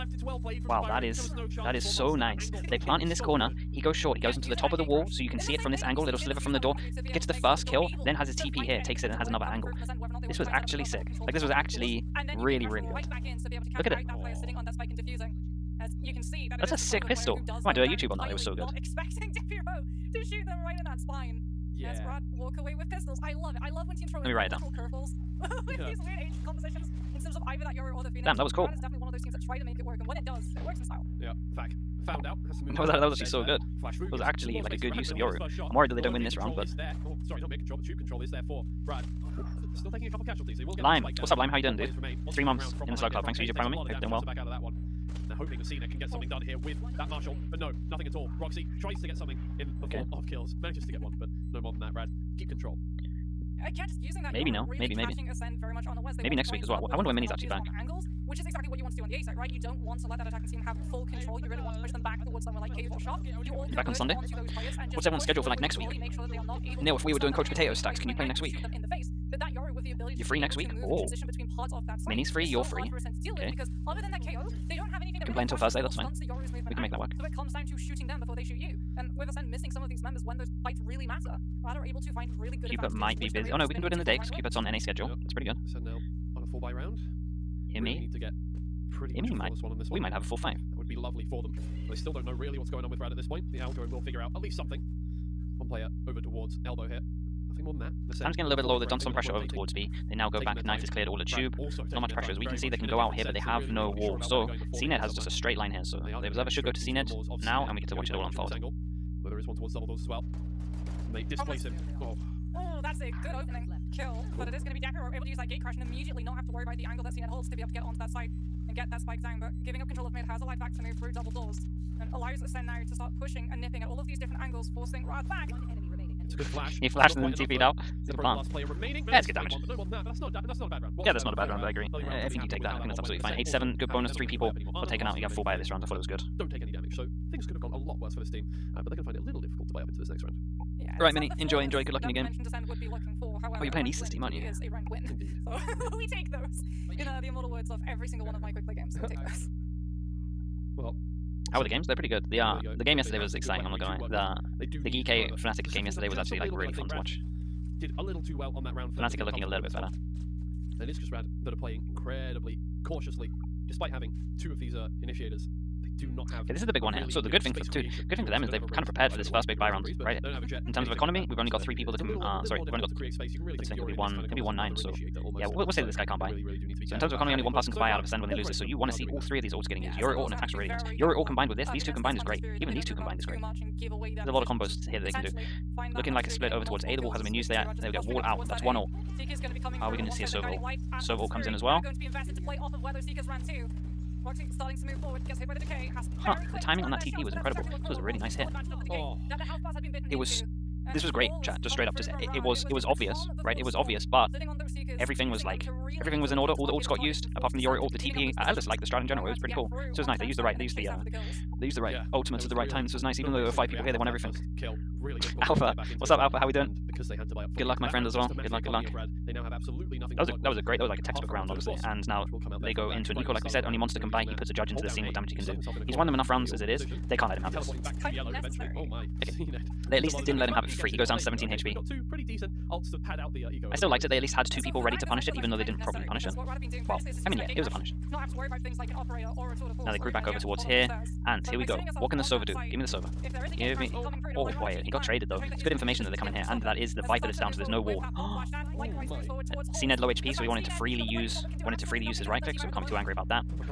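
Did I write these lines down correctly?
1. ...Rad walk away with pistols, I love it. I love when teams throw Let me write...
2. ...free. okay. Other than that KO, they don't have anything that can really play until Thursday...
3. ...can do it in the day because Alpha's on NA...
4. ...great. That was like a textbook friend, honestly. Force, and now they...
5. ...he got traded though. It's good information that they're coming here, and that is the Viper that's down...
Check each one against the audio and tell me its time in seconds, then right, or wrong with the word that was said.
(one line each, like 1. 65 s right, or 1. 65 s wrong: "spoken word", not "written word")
1. 22 s right
2. 72 s right
3. 83 s wrong: "Cupid", not "Alpha"
4. 220 s wrong: "round", not "friend"
5. 244 s right.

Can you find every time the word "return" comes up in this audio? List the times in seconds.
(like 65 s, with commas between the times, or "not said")
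not said.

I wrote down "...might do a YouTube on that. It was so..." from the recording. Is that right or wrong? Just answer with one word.
right.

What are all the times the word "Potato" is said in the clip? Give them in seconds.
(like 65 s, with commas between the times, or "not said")
67 s.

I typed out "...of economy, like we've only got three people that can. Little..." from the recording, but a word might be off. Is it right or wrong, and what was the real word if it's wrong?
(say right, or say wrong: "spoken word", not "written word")
right.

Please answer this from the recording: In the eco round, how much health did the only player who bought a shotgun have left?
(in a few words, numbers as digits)
17 HP.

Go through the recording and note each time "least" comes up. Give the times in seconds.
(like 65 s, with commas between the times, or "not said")
94 s, 230 s, 234 s.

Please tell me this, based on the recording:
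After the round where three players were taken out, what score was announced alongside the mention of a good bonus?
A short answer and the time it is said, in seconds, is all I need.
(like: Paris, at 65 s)
8-7, at 133 s.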